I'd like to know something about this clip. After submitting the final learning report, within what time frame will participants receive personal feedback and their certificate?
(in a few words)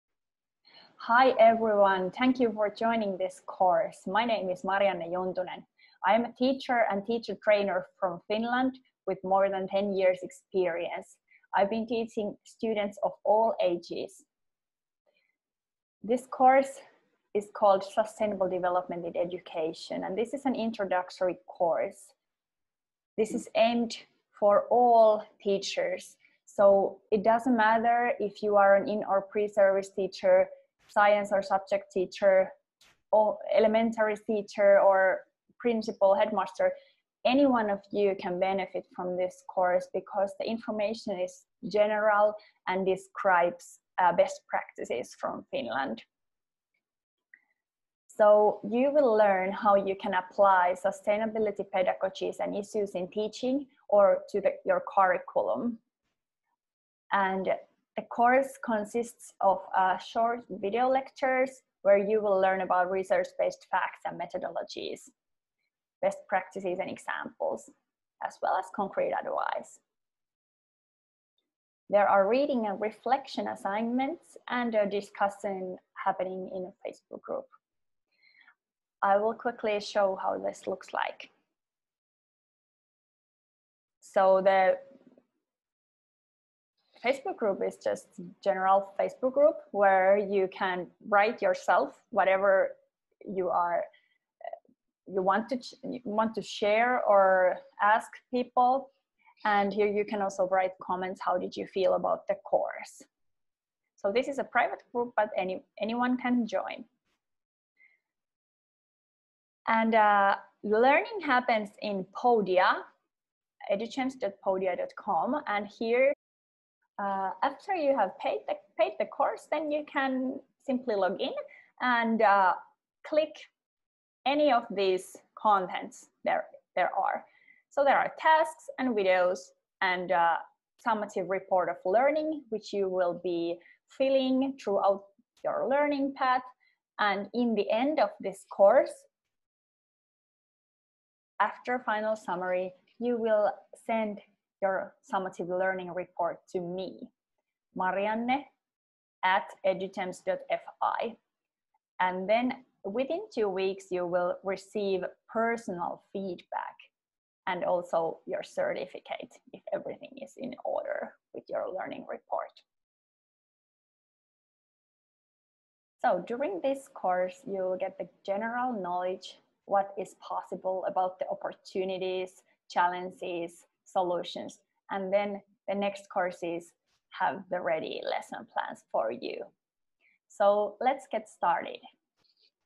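two weeks.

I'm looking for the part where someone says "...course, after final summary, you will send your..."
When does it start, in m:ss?
2:18.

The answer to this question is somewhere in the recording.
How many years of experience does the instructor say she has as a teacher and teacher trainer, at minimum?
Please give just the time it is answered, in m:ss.
0:09.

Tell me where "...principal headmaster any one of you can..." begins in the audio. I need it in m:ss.
0:35.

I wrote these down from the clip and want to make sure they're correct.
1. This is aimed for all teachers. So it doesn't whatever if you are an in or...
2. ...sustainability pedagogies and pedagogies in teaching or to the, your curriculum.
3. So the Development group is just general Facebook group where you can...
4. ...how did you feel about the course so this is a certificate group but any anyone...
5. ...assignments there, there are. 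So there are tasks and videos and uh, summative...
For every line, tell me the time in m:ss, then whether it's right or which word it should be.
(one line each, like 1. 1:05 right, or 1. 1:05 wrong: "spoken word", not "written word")
1. 0:23 wrong: "matter", not "whatever"
2. 0:50 wrong: "issues", not "pedagogies"
3. 1:23 wrong: "Facebook", not "Development"
4. 1:41 wrong: "private", not "certificate"
5. 2:05 wrong: "contents", not "assignments".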